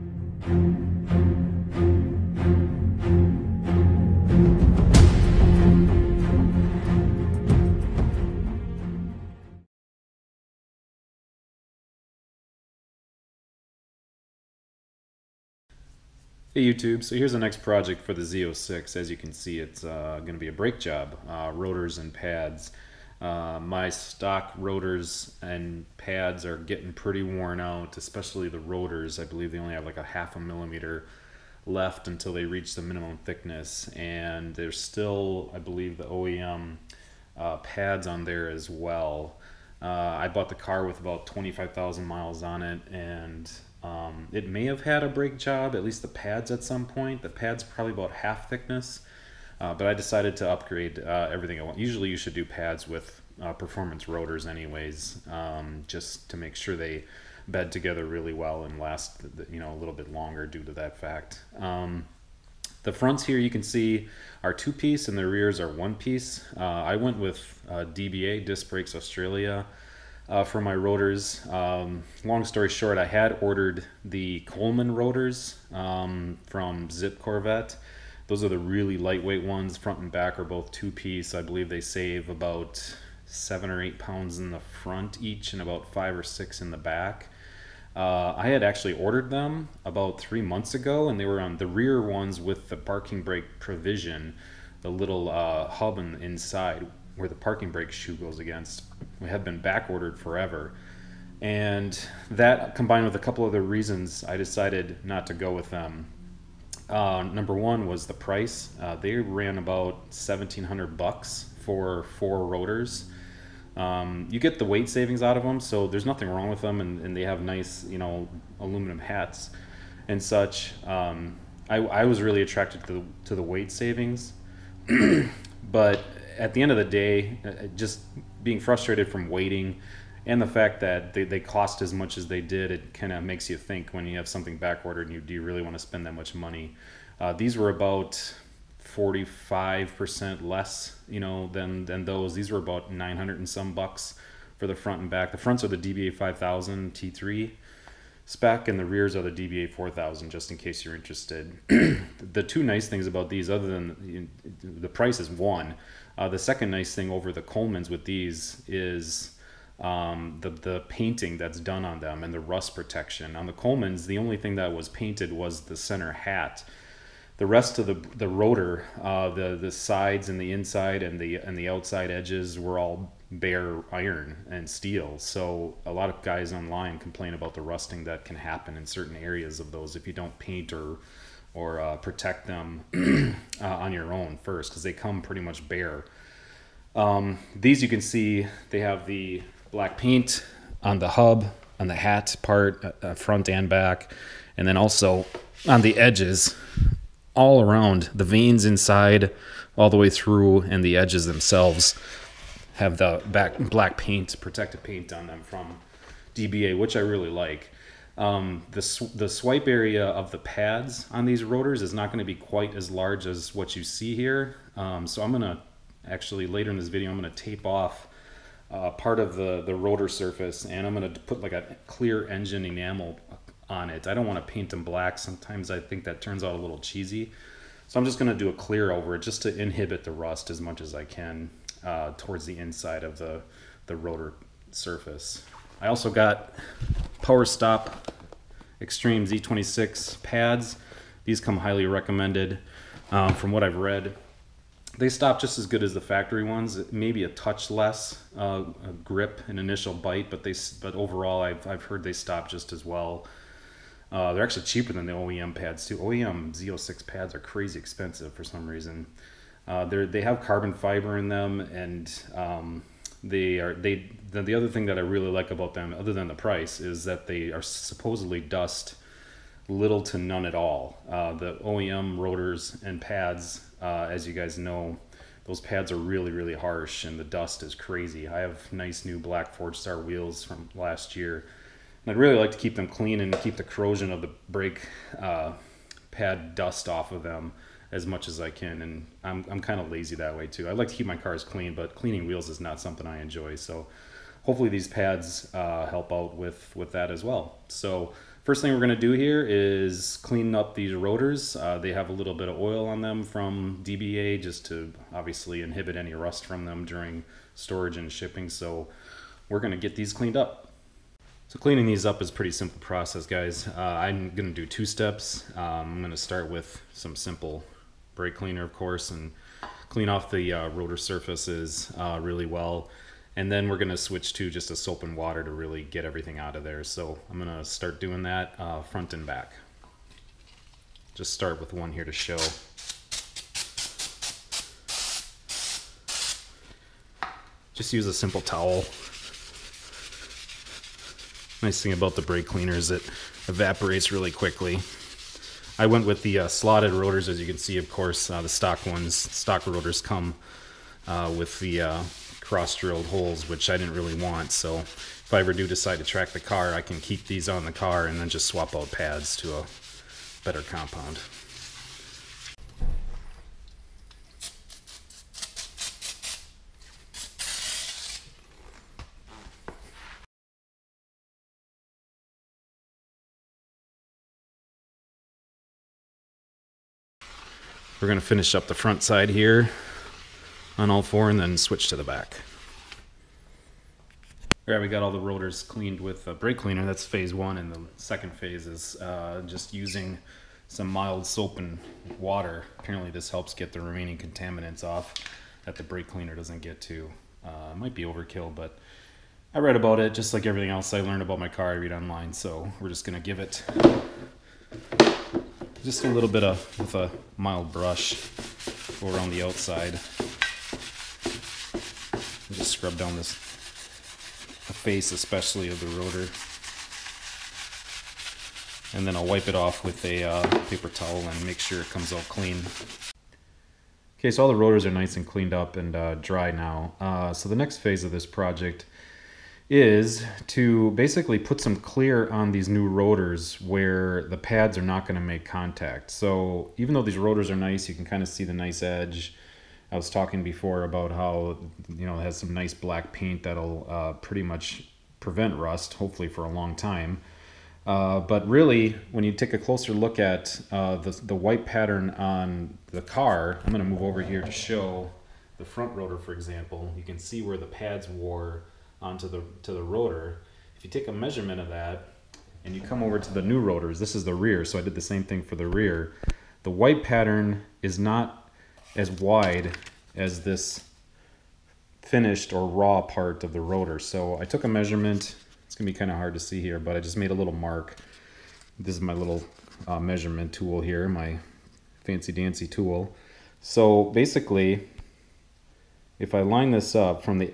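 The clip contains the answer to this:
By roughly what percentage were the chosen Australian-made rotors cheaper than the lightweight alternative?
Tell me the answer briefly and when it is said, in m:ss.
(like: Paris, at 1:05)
45%, at 2:18.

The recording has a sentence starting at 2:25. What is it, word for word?
The fronts are the DBA 5000 T3 spec and the rears are the DBA 4000 just in case you're interested.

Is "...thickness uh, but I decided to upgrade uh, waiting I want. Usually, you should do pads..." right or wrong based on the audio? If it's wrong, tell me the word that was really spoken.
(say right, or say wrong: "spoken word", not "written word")
wrong: "everything", not "waiting".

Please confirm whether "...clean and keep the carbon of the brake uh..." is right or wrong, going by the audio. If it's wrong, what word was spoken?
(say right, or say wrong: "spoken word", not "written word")
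wrong: "corrosion", not "carbon".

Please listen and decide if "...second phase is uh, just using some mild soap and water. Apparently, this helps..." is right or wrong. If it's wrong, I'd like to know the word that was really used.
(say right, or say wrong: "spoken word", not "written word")
right.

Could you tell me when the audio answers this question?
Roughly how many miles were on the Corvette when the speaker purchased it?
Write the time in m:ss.
0:41.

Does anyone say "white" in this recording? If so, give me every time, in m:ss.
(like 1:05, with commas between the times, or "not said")
7:31, 7:46.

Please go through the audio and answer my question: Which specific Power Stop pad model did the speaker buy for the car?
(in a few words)
Extreme Z26.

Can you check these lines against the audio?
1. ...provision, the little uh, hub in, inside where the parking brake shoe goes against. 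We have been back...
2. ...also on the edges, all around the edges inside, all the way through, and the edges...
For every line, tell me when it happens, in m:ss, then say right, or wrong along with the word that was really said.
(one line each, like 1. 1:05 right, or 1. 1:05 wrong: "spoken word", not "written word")
1. 1:33 right
2. 3:14 wrong: "vanes", not "edges".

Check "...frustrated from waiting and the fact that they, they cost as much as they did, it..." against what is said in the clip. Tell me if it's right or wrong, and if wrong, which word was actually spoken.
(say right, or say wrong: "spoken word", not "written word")
right.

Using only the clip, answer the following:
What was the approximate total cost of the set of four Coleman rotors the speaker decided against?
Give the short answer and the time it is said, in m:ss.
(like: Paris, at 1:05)
$1,700, at 1:50.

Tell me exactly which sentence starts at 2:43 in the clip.
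On the Coleman's, the only thing that was painted was the center hat.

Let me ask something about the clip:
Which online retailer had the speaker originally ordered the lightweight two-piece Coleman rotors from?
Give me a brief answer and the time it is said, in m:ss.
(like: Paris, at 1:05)
Zip Corvette, at 1:16.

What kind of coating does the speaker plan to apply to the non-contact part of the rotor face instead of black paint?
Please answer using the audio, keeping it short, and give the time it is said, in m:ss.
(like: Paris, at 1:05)
clear engine enamel, at 3:41.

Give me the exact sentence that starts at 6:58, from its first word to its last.
And then I'll wipe it off with a uh, paper towel and make sure it comes out clean.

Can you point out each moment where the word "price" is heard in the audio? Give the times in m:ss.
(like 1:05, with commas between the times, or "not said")
1:48, 2:34, 4:26.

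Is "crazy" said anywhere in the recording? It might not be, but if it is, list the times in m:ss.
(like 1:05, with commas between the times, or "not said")
4:17, 4:37.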